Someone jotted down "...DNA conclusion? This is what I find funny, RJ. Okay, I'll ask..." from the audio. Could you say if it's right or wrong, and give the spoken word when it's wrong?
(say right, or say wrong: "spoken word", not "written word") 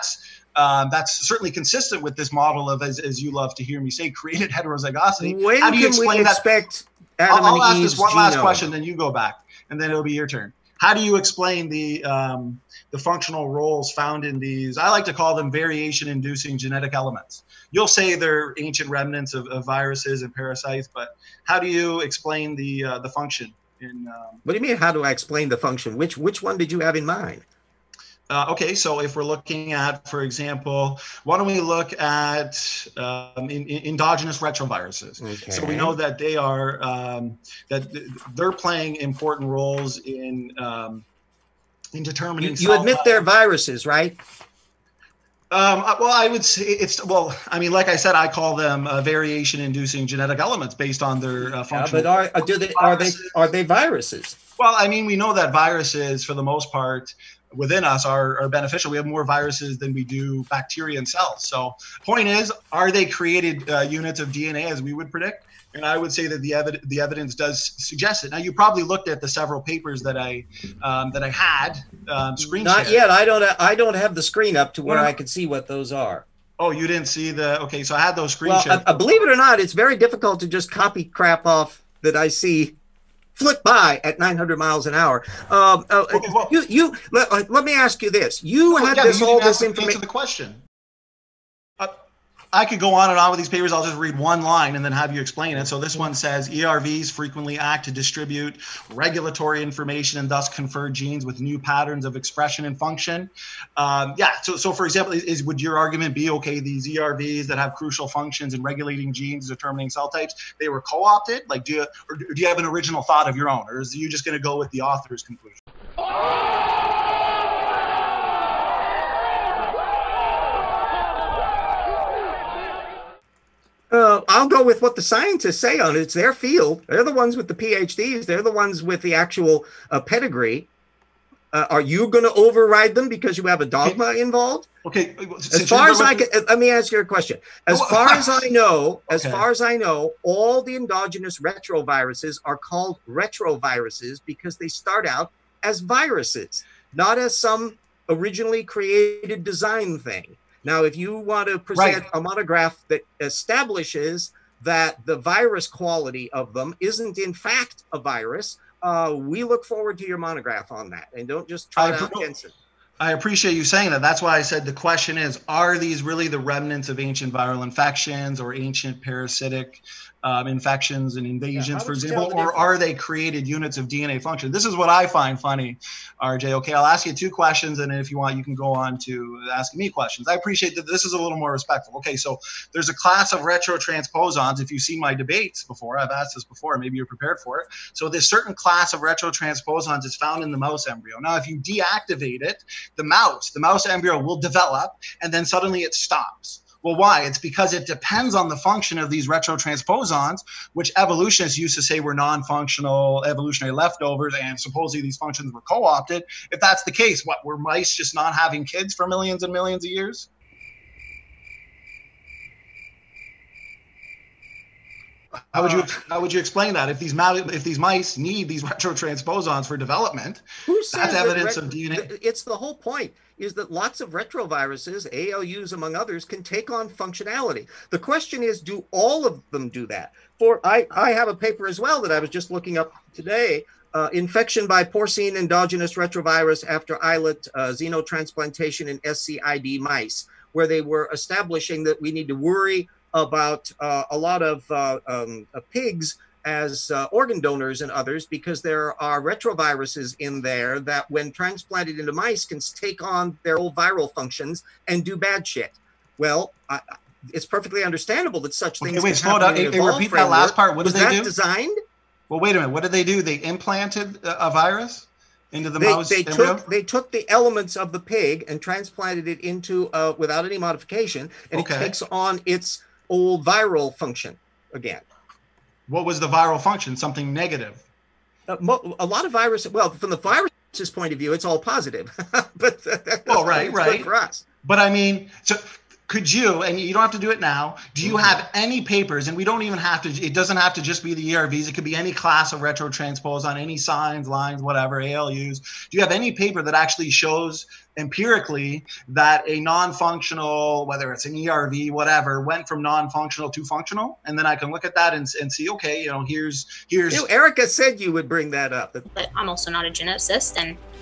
wrong: "function", not "conclusion".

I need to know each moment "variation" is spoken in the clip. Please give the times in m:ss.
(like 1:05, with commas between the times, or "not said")
0:15, 0:49.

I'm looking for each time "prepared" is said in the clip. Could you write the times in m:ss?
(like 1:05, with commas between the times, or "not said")
3:07.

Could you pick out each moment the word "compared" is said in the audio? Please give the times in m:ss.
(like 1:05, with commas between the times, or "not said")
not said.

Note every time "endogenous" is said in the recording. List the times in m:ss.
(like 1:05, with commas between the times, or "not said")
0:33, 2:20, 3:55.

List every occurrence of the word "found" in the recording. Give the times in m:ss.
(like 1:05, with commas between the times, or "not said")
0:13, 3:10.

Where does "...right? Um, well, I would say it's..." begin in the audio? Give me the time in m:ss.
0:43.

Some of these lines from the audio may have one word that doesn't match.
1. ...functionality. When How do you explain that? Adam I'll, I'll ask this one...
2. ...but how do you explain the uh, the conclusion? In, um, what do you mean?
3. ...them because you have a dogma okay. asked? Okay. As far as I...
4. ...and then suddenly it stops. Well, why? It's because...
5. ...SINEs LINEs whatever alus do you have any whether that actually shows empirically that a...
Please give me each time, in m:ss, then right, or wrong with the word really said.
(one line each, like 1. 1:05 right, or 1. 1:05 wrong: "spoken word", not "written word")
1. 0:04 wrong: "heterozygosity", not "functionality"
2. 0:20 wrong: "function", not "conclusion"
3. 2:12 wrong: "involved", not "asked"
4. 3:15 right
5. 4:53 wrong: "paper", not "whether".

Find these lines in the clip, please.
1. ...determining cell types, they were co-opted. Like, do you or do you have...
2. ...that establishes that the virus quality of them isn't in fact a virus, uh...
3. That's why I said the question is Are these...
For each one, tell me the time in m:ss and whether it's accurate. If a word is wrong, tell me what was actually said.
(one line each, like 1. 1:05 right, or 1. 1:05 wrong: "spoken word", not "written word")
1. 1:49 right
2. 2:32 right
3. 2:44 right.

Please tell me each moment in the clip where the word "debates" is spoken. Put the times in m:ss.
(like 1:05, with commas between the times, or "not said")
3:05.